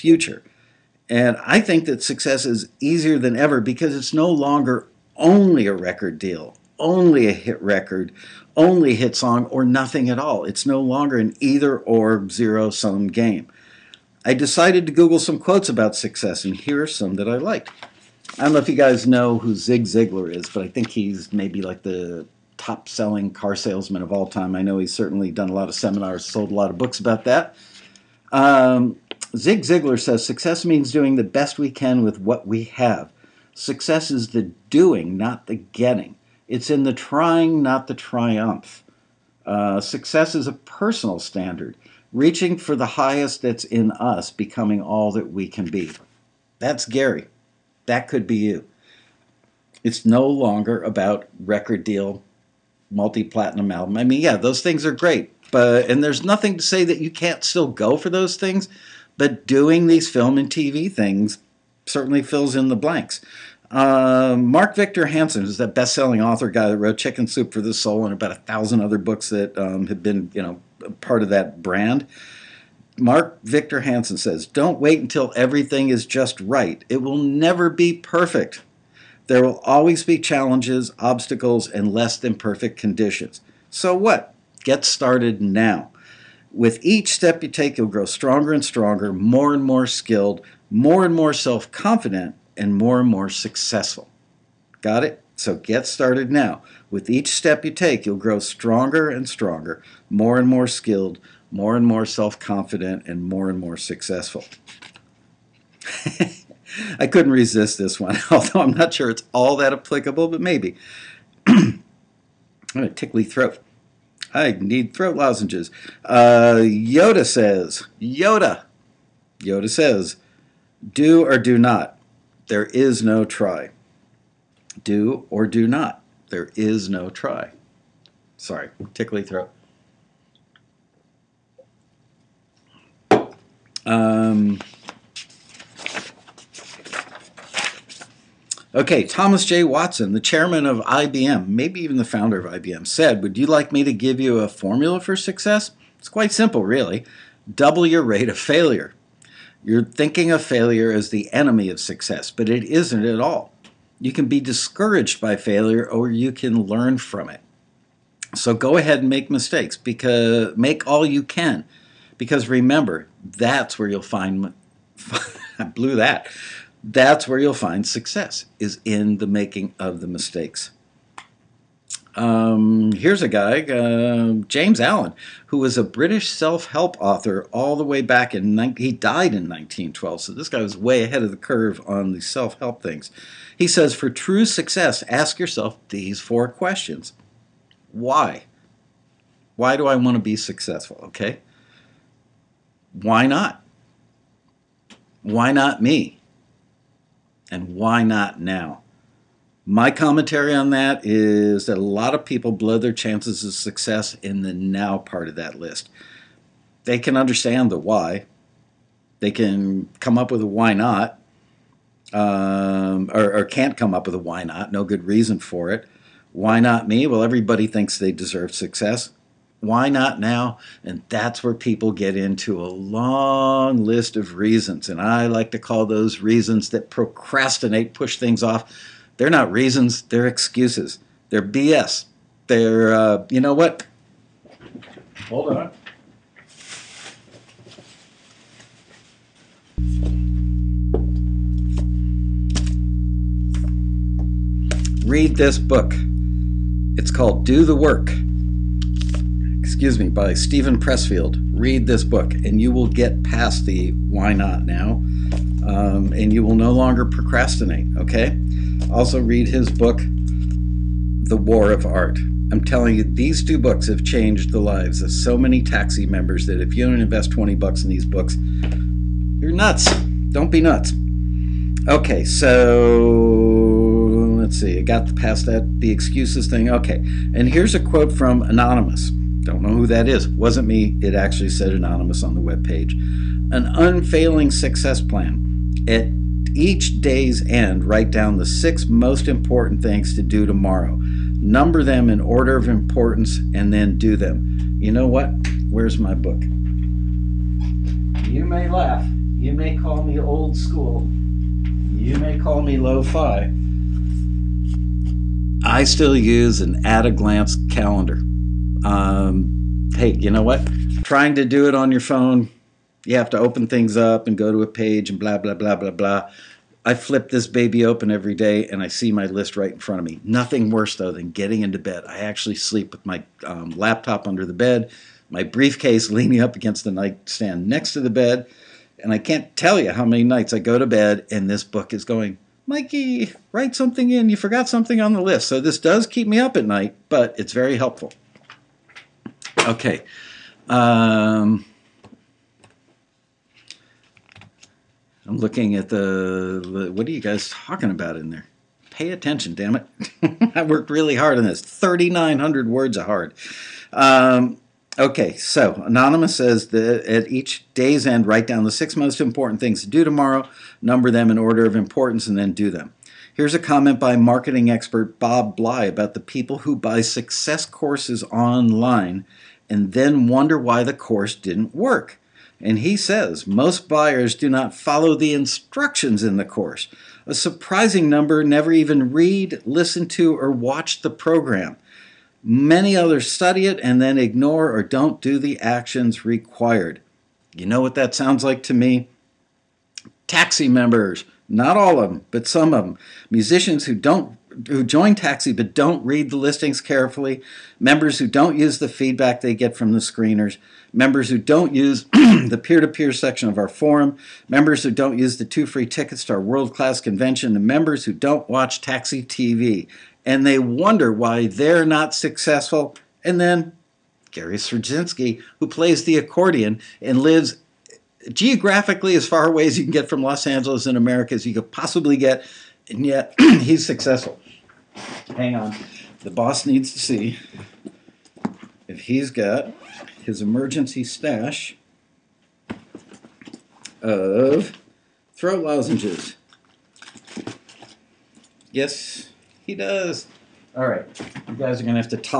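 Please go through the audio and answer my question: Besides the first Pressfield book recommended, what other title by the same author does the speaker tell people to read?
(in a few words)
The War of Art.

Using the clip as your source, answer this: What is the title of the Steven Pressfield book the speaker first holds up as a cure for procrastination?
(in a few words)
Do the Work.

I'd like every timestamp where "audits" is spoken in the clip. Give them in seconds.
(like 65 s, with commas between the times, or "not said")
not said.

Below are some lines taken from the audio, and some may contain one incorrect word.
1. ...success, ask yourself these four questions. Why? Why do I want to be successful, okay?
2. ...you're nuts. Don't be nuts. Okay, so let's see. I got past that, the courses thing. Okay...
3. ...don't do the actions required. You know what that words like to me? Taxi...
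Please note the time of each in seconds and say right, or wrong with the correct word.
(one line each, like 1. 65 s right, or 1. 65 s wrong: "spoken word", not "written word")
1. 184 s right
2. 269 s wrong: "excuses", not "courses"
3. 384 s wrong: "sounds", not "words".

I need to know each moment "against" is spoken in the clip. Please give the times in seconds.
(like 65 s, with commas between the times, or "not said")
326 s.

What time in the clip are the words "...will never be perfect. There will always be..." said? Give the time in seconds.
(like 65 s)
77 s.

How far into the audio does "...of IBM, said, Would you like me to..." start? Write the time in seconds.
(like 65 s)
142 s.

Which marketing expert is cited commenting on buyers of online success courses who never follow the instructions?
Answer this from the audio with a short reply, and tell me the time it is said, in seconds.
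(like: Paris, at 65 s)
Bob Bly, at 365 s.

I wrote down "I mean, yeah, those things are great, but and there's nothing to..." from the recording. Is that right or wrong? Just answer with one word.
right.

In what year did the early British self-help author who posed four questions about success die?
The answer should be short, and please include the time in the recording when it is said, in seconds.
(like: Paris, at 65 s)
1912, at 179 s.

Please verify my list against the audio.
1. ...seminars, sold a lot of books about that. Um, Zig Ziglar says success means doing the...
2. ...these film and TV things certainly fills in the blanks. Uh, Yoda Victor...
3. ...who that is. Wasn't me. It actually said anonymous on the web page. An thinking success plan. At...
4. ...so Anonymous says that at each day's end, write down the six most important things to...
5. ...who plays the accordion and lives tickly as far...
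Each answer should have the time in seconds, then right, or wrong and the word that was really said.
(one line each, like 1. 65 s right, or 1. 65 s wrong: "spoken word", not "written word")
1. 25 s right
2. 59 s wrong: "Mark", not "Yoda"
3. 279 s wrong: "unfailing", not "thinking"
4. 355 s right
5. 415 s wrong: "geographically", not "tickly".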